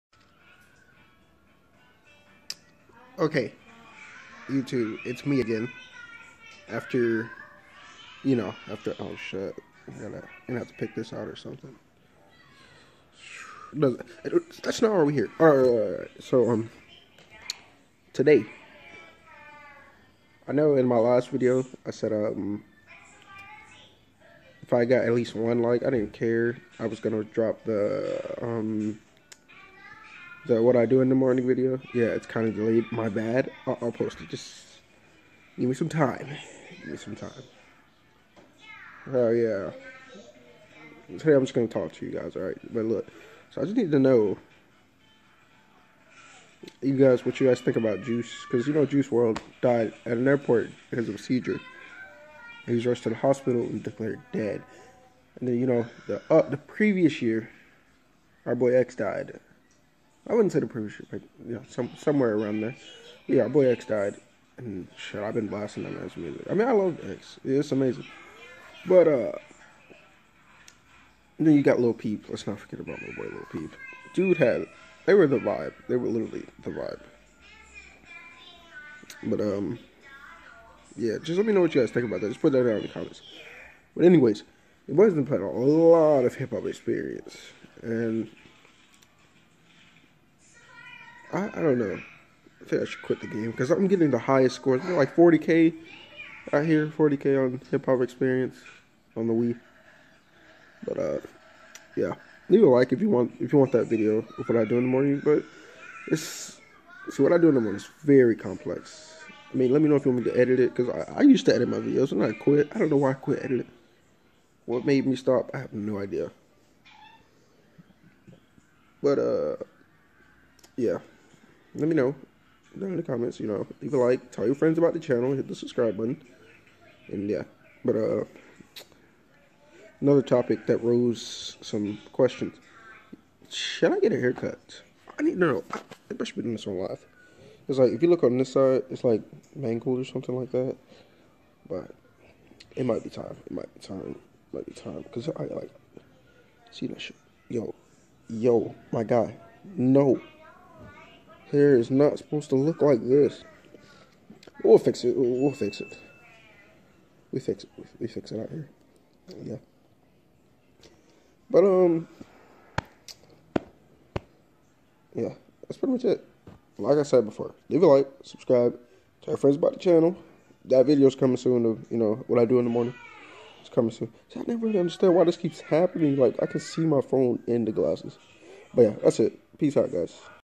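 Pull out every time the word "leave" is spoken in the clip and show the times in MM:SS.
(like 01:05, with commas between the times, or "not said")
01:42, 02:03, 02:47.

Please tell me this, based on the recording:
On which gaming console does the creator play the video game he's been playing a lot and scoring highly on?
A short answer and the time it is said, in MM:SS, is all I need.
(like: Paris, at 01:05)
Wii, at 01:39.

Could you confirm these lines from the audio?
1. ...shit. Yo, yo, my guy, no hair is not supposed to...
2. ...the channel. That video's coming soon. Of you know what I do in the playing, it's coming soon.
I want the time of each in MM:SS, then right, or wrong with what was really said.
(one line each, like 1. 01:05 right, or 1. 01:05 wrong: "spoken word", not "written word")
1. 02:27 right
2. 02:49 wrong: "morning", not "playing".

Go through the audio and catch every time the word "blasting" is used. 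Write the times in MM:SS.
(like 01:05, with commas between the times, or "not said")
01:05.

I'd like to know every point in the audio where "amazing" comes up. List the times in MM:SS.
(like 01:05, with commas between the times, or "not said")
01:07.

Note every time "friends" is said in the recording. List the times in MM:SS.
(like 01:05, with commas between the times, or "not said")
02:04, 02:49.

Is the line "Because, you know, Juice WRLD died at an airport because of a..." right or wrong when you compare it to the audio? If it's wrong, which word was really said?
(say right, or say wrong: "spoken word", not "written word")
right.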